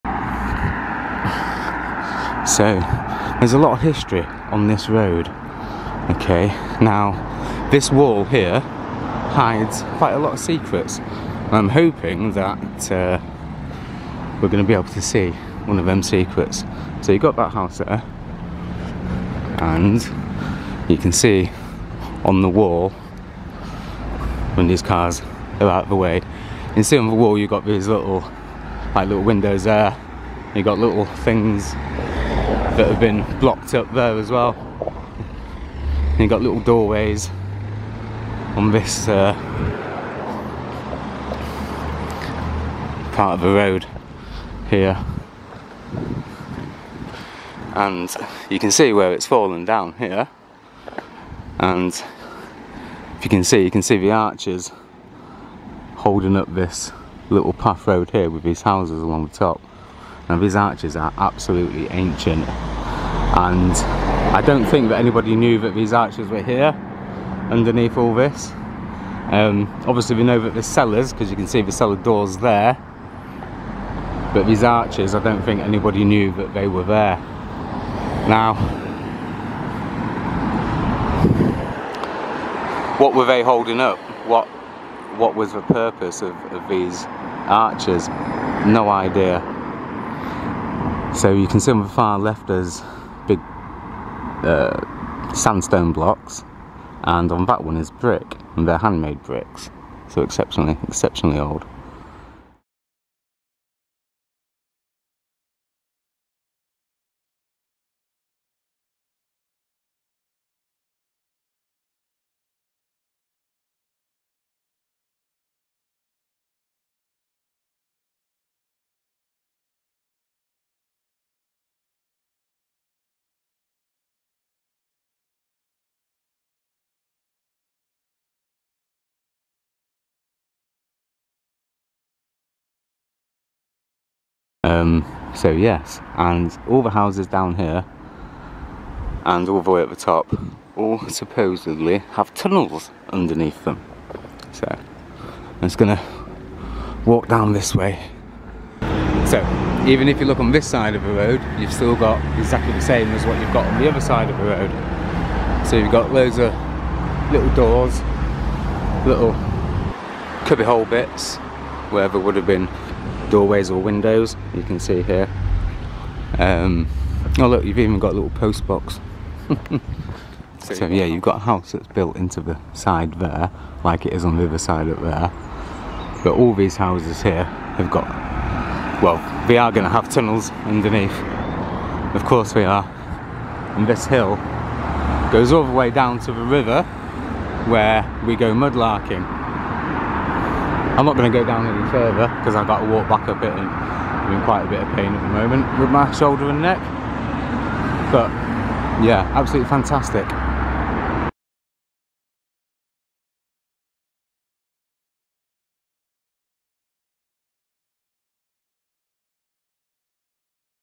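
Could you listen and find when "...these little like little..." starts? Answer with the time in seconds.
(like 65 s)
27 s.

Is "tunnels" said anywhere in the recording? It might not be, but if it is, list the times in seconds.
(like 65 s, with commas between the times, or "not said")
142 s, 180 s.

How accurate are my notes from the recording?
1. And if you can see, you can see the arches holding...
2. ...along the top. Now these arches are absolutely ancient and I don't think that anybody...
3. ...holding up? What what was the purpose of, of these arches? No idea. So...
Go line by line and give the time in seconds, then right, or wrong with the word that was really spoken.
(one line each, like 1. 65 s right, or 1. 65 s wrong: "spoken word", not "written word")
1. 51 s right
2. 59 s right
3. 83 s right.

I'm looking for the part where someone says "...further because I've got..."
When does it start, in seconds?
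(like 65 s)
191 s.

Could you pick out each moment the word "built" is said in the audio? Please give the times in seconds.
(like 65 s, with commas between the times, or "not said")
171 s.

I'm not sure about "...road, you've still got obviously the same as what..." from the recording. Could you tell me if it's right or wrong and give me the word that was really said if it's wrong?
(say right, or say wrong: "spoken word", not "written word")
wrong: "exactly", not "obviously".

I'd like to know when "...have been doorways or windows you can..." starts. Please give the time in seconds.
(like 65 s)
162 s.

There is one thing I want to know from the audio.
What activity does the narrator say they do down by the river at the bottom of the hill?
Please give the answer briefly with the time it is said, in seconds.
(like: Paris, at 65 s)
Mudlarking, at 188 s.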